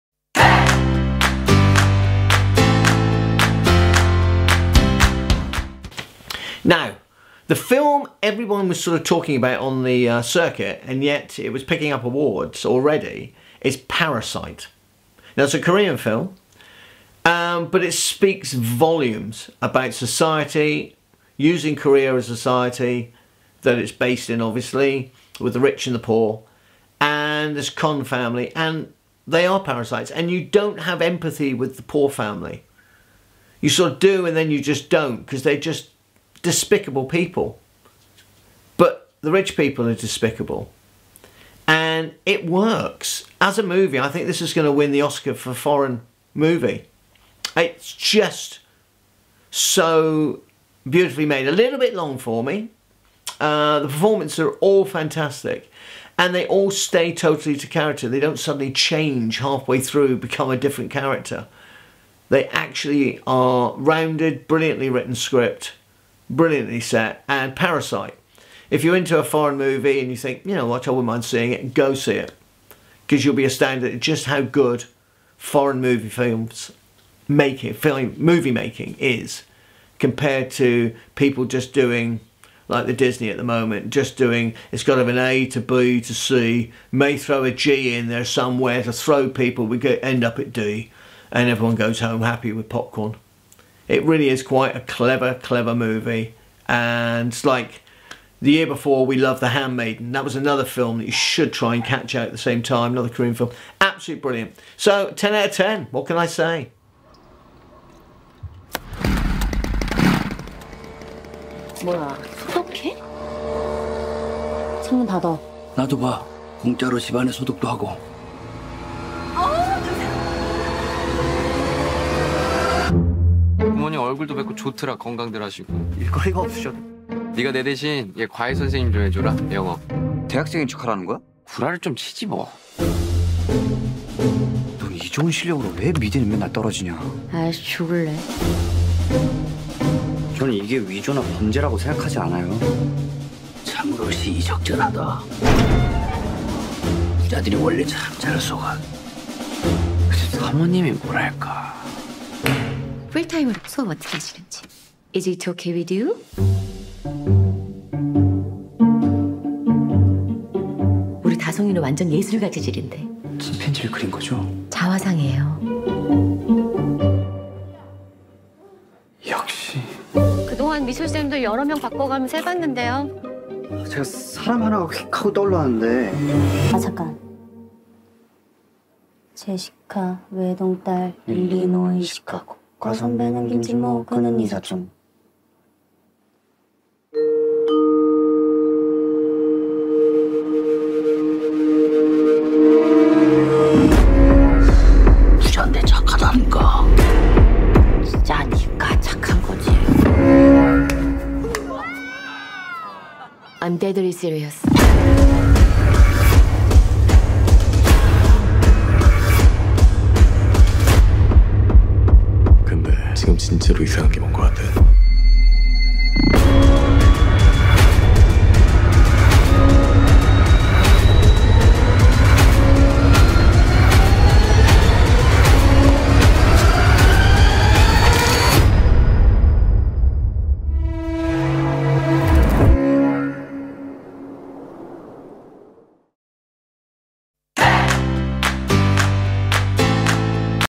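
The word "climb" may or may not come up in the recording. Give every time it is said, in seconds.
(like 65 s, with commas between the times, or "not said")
not said.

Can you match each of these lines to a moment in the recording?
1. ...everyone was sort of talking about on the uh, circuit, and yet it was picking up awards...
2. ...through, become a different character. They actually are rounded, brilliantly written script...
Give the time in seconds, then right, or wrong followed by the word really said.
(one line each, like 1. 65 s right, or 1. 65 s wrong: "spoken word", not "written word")
1. 8 s right
2. 59 s right.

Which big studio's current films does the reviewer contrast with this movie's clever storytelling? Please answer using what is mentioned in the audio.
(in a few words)
Disney.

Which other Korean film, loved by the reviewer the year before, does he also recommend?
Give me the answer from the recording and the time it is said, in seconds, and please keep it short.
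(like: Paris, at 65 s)
The Handmaiden, at 99 s.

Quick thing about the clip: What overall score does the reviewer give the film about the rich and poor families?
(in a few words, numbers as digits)
10 out of 10.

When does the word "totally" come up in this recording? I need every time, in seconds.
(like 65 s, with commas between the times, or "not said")
57 s.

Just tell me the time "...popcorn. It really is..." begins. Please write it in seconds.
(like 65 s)
92 s.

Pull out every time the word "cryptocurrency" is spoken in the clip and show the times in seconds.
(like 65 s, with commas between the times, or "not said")
not said.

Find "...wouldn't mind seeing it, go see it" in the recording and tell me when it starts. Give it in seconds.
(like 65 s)
70 s.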